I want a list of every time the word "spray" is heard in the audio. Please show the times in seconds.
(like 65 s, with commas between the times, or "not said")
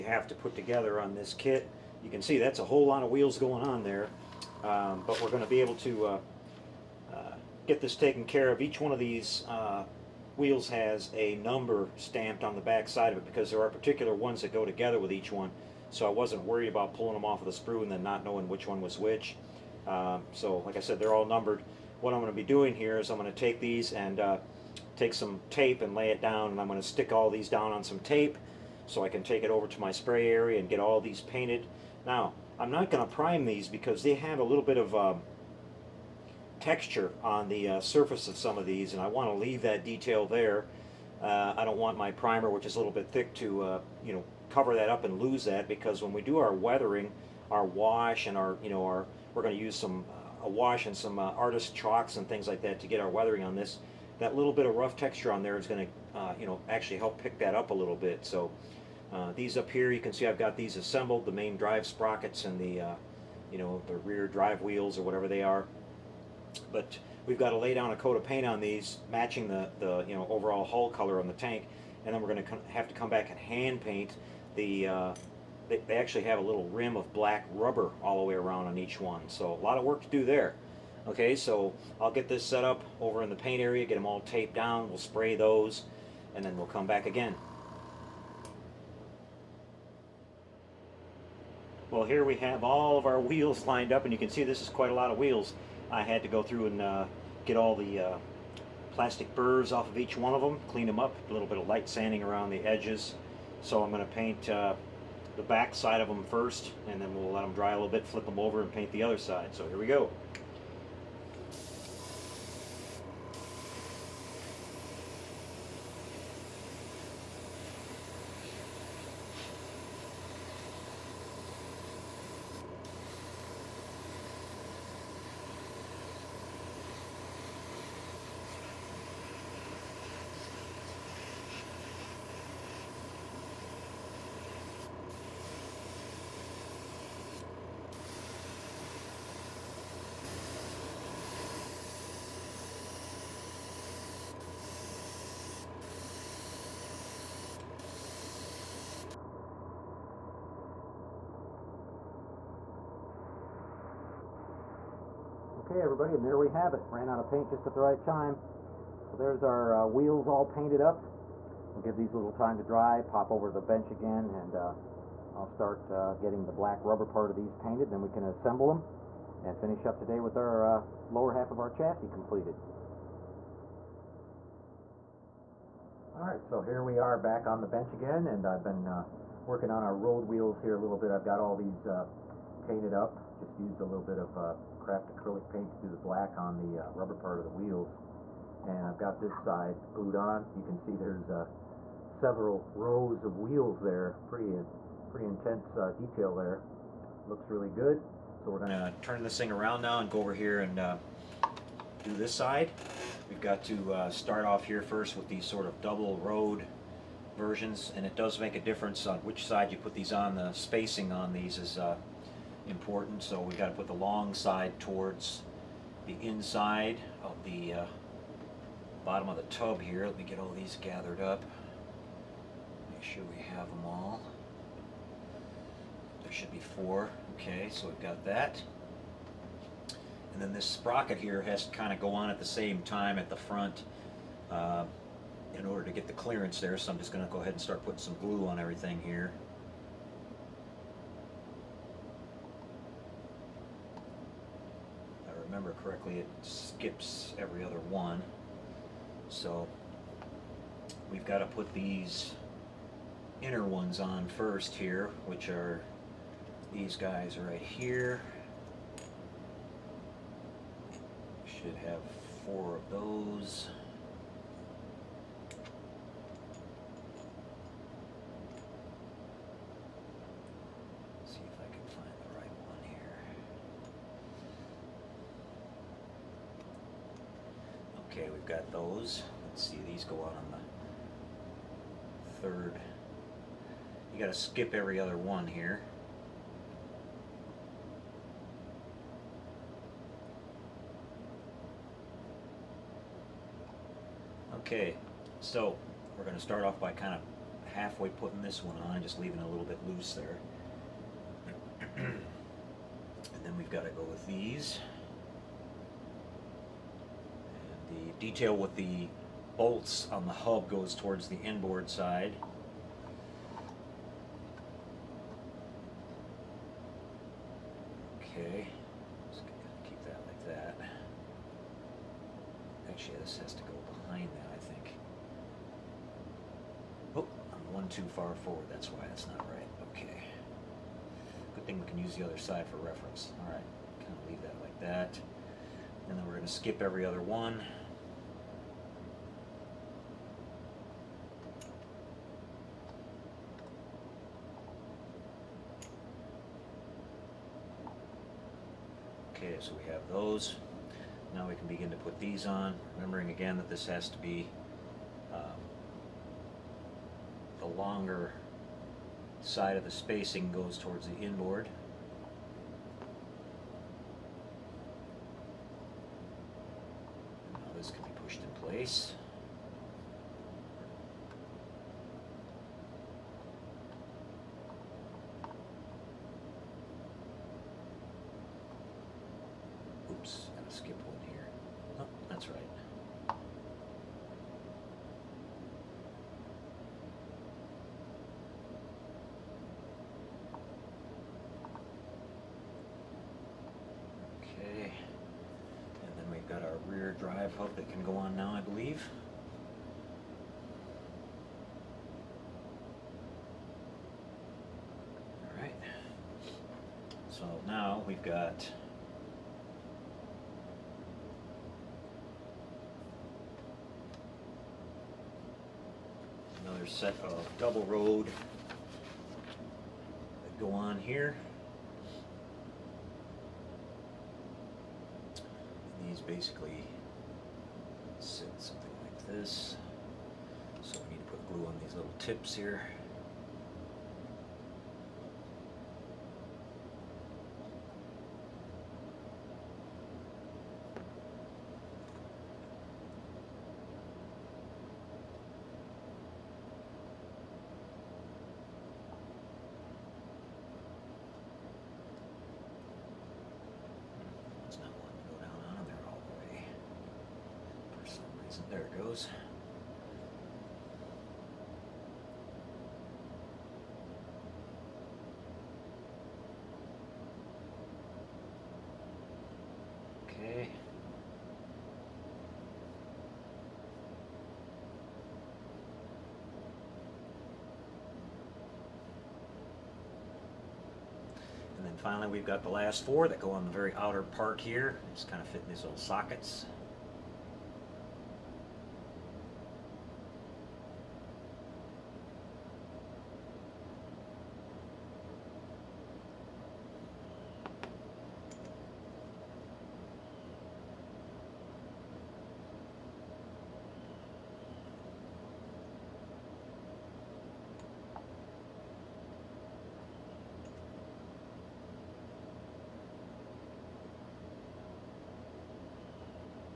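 29 s, 84 s.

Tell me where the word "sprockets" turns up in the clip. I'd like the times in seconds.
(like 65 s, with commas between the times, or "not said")
61 s, 230 s.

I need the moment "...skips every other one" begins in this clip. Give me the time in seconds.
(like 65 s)
246 s.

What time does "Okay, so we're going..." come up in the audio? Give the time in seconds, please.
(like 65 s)
294 s.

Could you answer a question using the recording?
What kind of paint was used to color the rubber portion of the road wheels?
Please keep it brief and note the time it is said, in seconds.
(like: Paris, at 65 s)
Craft acrylic paint, at 184 s.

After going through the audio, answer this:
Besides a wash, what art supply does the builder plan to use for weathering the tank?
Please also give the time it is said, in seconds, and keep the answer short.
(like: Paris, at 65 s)
Artist chalks, at 51 s.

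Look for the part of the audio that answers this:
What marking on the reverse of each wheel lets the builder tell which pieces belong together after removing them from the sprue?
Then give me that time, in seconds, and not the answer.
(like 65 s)
11 s.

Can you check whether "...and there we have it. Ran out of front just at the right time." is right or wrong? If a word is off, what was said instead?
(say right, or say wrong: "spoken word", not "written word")
wrong: "paint", not "front".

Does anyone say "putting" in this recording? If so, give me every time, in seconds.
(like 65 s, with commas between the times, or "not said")
237 s, 298 s.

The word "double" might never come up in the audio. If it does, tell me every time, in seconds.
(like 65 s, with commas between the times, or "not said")
205 s, 417 s.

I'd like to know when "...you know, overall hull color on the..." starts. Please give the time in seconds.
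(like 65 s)
70 s.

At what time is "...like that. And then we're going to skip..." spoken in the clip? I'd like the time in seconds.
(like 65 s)
334 s.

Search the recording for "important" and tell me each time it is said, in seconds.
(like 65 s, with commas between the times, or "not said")
212 s.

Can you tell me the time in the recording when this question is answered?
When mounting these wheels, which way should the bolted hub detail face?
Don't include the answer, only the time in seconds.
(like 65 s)
311 s.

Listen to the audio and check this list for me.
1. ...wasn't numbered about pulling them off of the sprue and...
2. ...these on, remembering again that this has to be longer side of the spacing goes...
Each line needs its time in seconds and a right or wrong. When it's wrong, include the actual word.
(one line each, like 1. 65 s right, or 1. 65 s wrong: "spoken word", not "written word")
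1. 16 s wrong: "worried", not "numbered"
2. 352 s right.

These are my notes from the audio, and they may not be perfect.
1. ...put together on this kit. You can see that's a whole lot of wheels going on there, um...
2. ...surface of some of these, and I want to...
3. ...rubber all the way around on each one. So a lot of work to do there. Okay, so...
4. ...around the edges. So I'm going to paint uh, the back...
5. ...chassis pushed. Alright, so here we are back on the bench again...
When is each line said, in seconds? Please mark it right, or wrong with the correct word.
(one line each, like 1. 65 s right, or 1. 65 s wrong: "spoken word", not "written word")
1. 0 s right
2. 37 s right
3. 77 s right
4. 102 s right
5. 171 s wrong: "completed", not "pushed".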